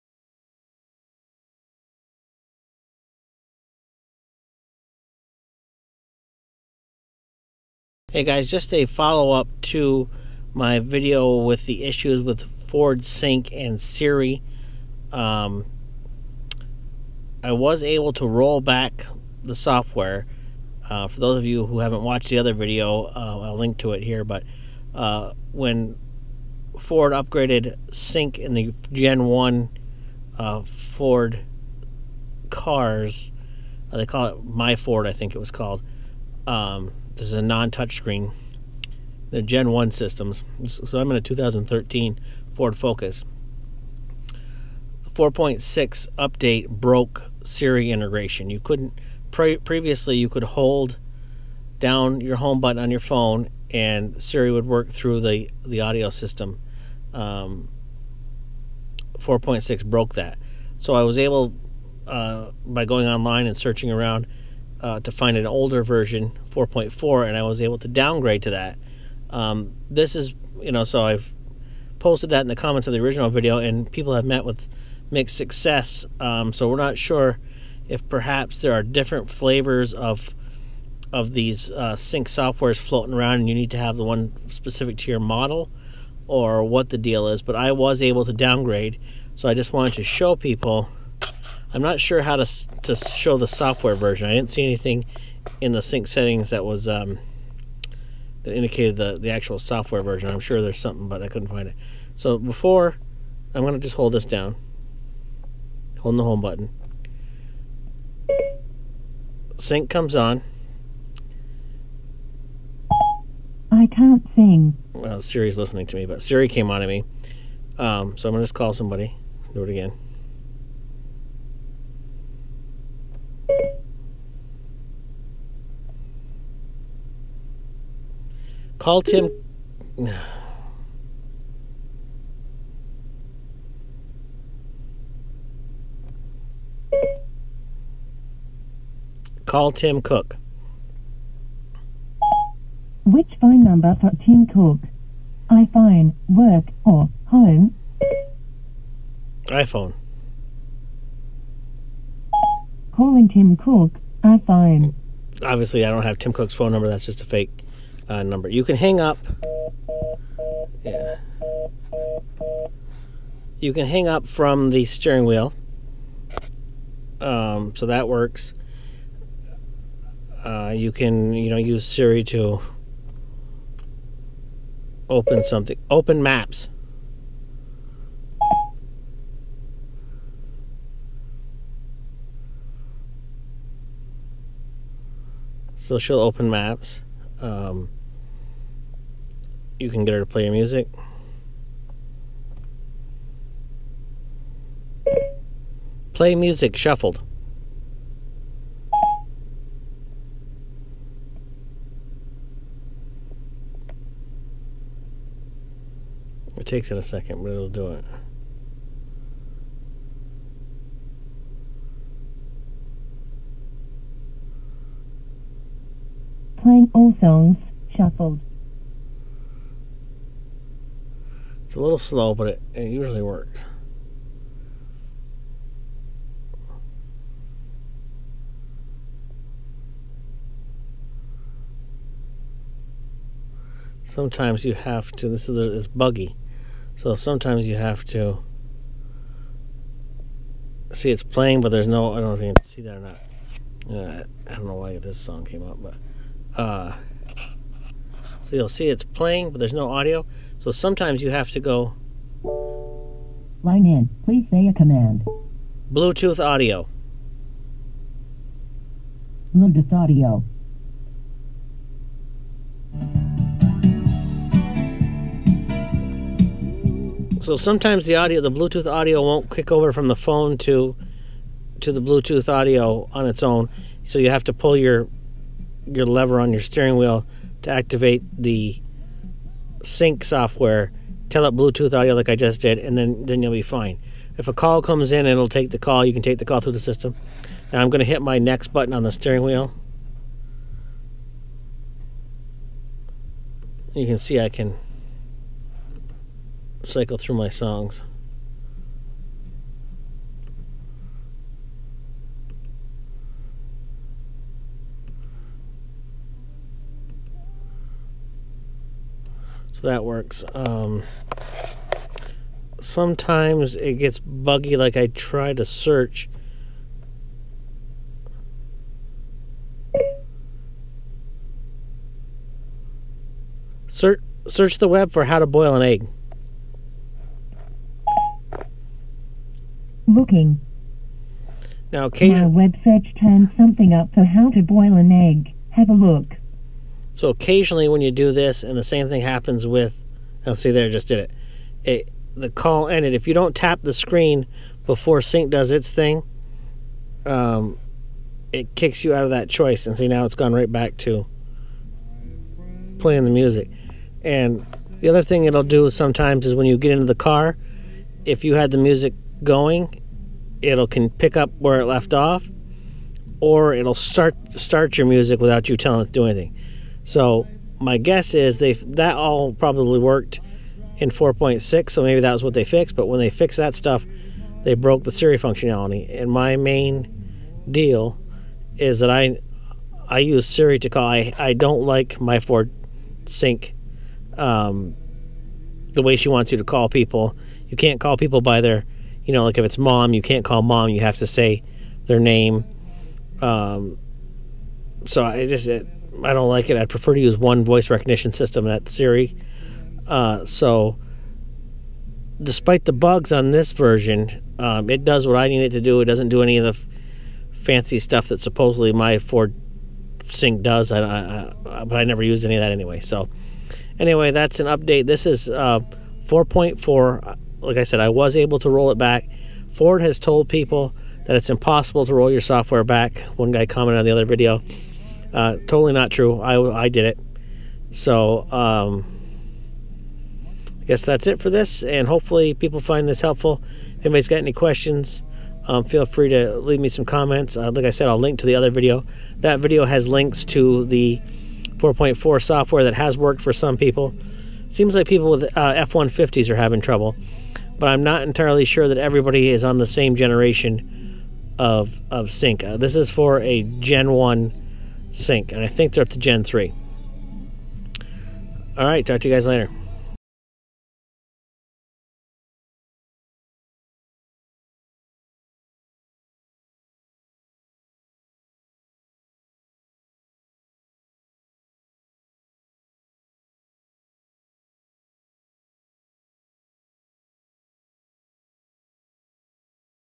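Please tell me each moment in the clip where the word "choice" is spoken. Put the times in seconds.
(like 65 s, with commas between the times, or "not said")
349 s.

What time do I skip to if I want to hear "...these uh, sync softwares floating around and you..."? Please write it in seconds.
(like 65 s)
81 s.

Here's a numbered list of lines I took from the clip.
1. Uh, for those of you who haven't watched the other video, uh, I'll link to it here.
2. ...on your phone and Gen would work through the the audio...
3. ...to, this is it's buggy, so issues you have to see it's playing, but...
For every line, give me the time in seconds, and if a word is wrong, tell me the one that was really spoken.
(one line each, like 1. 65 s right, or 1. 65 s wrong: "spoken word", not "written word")
1. 20 s right
2. 52 s wrong: "Siri", not "Gen"
3. 235 s wrong: "sometimes", not "issues".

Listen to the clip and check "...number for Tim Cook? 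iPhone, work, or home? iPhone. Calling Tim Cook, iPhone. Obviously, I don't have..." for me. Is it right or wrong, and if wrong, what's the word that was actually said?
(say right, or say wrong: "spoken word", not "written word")
right.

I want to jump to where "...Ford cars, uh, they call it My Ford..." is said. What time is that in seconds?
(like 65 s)
30 s.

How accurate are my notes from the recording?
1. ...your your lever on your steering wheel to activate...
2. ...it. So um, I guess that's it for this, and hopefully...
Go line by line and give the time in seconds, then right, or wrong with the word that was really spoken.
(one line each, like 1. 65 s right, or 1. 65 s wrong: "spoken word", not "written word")
1. 274 s right
2. 427 s right.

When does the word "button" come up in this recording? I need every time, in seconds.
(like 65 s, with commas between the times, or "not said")
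52 s, 106 s, 288 s.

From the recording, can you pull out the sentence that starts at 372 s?
But when they fixed that stuff, they broke the Siri functionality.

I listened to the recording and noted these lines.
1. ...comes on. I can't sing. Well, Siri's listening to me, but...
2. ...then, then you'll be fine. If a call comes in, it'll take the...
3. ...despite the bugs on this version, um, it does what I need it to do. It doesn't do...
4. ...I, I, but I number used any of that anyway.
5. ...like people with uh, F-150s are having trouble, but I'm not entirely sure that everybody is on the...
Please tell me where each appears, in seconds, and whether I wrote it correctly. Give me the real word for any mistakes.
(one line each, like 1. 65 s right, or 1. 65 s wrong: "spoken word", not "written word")
1. 109 s right
2. 282 s right
3. 402 s right
4. 411 s wrong: "never", not "number"
5. 444 s right.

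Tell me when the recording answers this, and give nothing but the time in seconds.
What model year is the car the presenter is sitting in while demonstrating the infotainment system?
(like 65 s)
41 s.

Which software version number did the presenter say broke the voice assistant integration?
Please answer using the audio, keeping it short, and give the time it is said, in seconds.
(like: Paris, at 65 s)
4.6, at 45 s.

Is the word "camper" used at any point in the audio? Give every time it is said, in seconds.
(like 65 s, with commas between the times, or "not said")
not said.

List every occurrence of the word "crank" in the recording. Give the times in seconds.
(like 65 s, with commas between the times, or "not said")
not said.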